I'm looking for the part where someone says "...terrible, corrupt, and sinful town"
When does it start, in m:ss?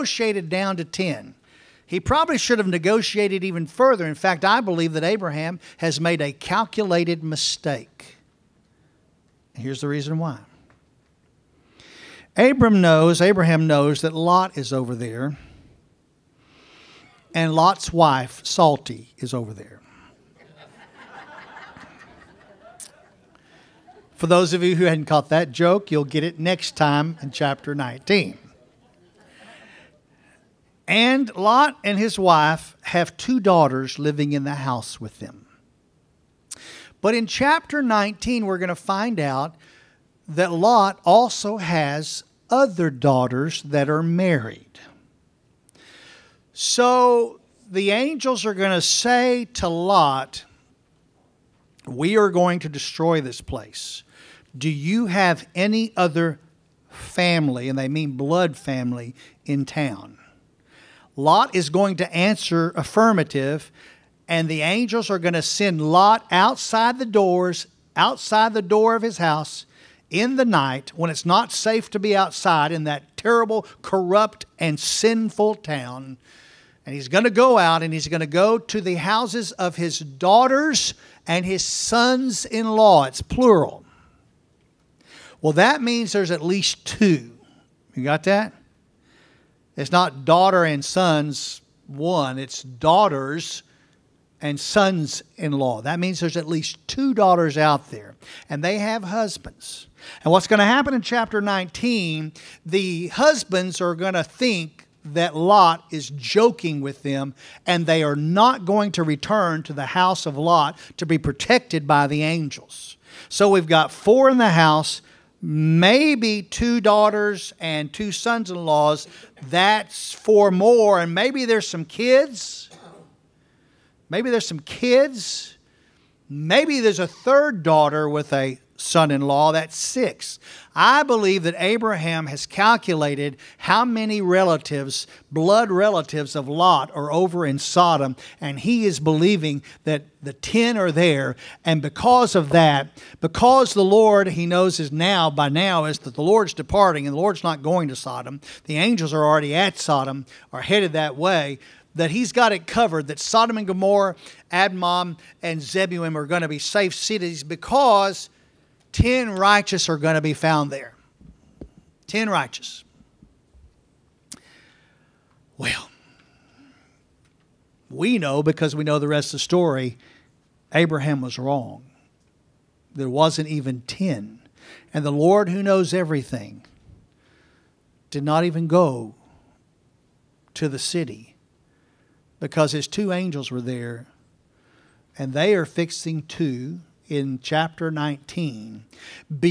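1:13.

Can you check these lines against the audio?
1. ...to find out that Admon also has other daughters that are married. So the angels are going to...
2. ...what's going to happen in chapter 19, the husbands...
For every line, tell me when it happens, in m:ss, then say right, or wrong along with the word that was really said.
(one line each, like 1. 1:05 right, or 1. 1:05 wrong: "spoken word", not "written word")
1. 0:38 wrong: "Lot", not "Admon"
2. 1:40 right.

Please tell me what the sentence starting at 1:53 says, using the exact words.
So we've got four in the house, maybe two daughters and two sons in laws.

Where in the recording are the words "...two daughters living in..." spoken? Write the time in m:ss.
0:33.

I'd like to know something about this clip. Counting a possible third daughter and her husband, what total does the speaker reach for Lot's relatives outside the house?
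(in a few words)
6.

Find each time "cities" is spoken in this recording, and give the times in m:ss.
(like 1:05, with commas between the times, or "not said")
2:36.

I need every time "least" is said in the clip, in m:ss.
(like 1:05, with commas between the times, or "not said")
1:26, 1:36.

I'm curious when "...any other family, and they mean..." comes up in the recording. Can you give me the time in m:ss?
0:55.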